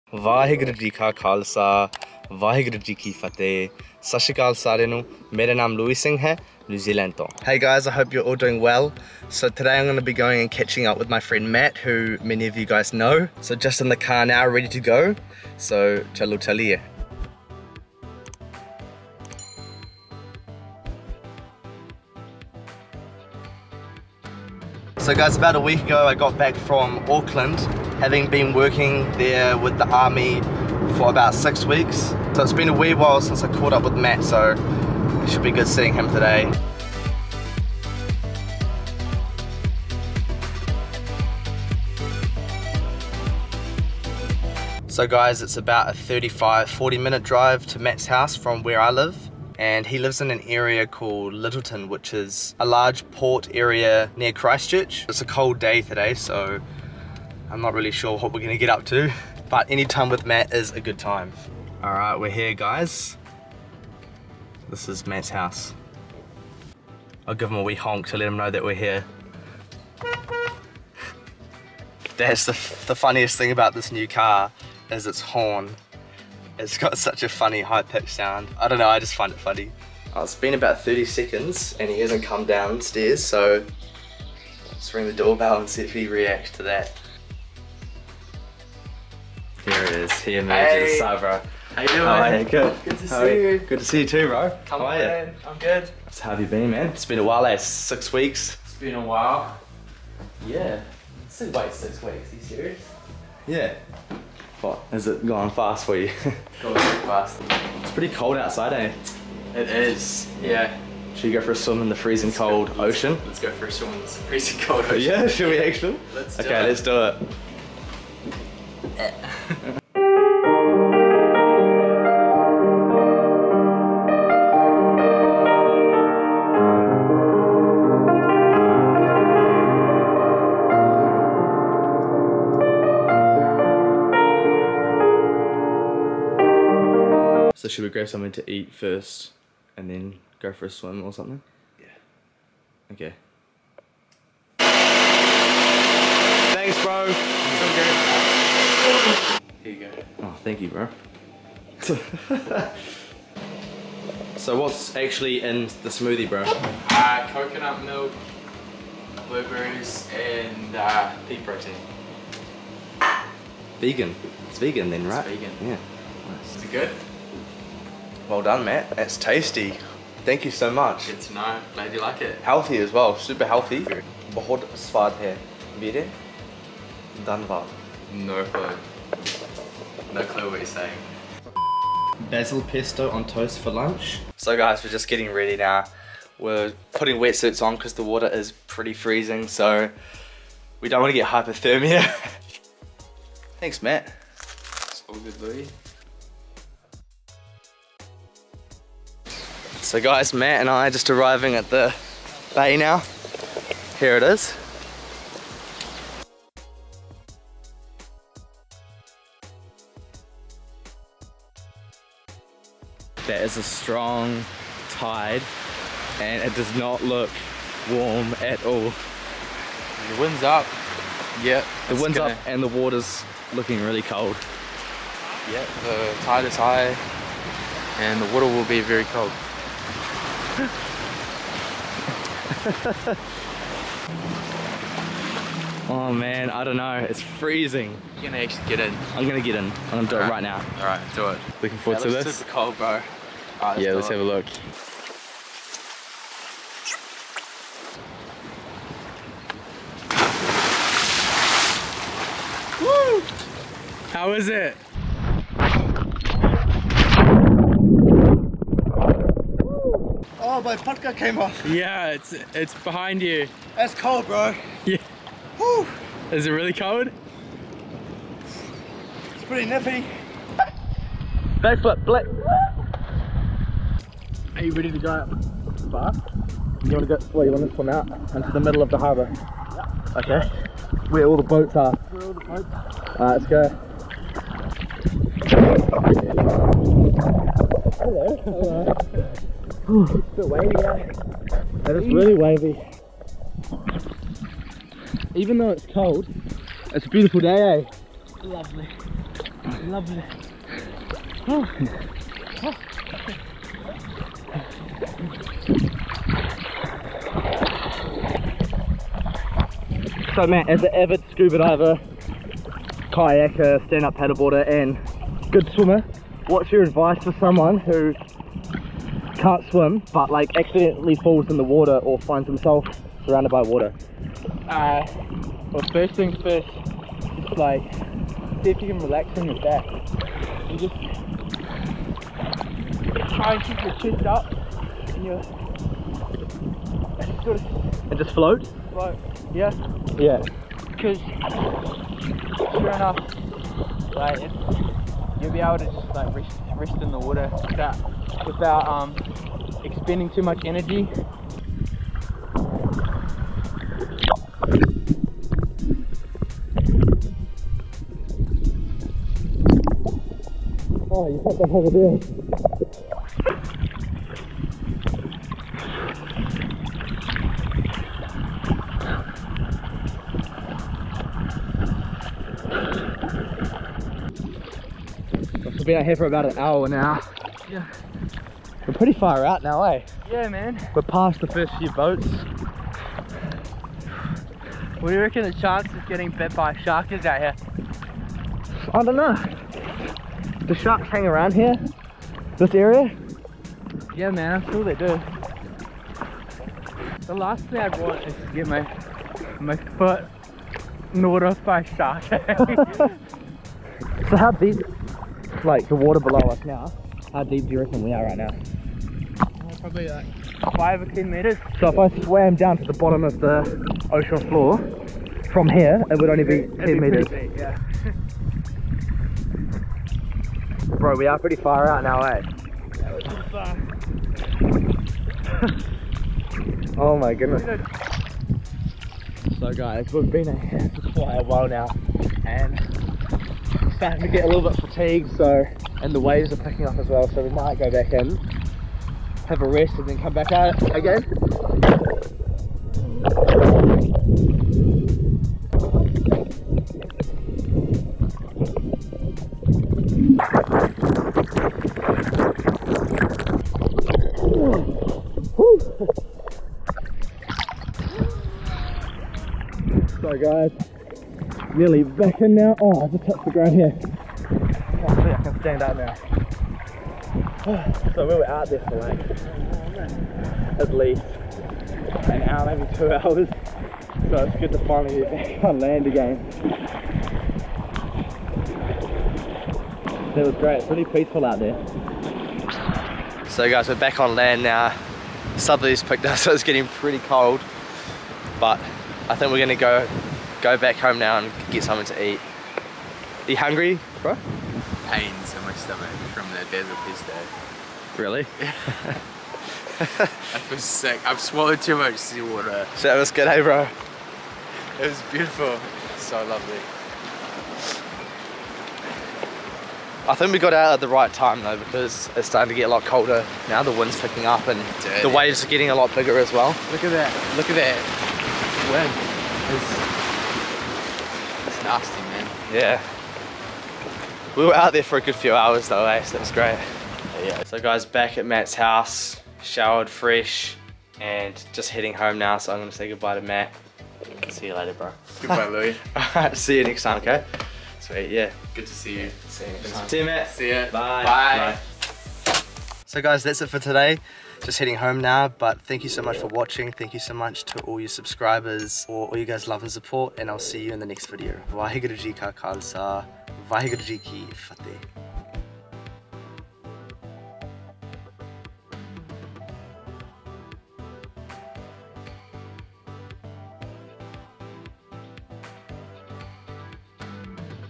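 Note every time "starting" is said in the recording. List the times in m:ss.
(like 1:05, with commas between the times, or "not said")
7:13, 8:32.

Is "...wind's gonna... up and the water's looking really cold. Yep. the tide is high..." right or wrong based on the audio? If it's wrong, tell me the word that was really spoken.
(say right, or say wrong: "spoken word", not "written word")
right.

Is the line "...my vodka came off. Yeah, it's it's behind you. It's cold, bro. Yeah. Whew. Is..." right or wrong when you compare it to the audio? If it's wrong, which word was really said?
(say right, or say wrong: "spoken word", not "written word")
right.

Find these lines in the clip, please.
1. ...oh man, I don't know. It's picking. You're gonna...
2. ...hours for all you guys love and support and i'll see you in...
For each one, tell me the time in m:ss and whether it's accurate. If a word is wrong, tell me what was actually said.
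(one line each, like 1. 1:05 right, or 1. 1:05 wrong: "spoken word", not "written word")
1. 3:55 wrong: "freezing", not "picking"
2. 9:08 wrong: "subscribers", not "hours".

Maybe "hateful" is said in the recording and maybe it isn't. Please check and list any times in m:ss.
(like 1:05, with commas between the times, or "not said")
not said.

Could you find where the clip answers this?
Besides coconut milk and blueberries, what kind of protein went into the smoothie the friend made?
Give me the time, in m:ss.
2:41.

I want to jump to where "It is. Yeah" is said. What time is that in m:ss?
1:49.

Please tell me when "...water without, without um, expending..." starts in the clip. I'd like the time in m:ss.
5:47.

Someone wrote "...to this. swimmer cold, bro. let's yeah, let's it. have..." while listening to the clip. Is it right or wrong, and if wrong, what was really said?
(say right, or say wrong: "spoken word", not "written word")
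wrong: "super", not "swimmer".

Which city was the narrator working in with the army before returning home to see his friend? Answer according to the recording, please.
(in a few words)
Auckland.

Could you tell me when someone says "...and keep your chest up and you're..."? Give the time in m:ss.
5:33.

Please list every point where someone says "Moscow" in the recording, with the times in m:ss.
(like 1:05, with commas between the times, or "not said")
not said.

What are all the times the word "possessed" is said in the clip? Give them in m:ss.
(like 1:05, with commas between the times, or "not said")
not said.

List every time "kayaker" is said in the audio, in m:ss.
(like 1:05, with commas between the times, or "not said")
5:13.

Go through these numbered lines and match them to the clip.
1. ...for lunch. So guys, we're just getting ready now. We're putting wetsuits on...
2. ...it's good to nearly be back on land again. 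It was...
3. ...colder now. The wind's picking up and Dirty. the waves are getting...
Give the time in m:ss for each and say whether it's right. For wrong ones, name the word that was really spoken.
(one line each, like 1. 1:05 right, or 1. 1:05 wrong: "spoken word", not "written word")
1. 3:03 right
2. 7:54 wrong: "finally", not "nearly"
3. 8:33 right.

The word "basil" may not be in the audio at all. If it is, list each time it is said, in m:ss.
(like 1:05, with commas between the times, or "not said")
3:02, 8:16.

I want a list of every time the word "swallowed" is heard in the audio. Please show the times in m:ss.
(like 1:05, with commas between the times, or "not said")
8:21.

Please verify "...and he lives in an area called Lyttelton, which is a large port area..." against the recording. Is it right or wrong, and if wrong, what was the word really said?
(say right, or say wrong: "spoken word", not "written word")
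right.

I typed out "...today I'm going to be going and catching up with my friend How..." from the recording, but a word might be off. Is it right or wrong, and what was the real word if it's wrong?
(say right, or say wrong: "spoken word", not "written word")
wrong: "Matt", not "How".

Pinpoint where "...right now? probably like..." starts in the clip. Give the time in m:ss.
6:48.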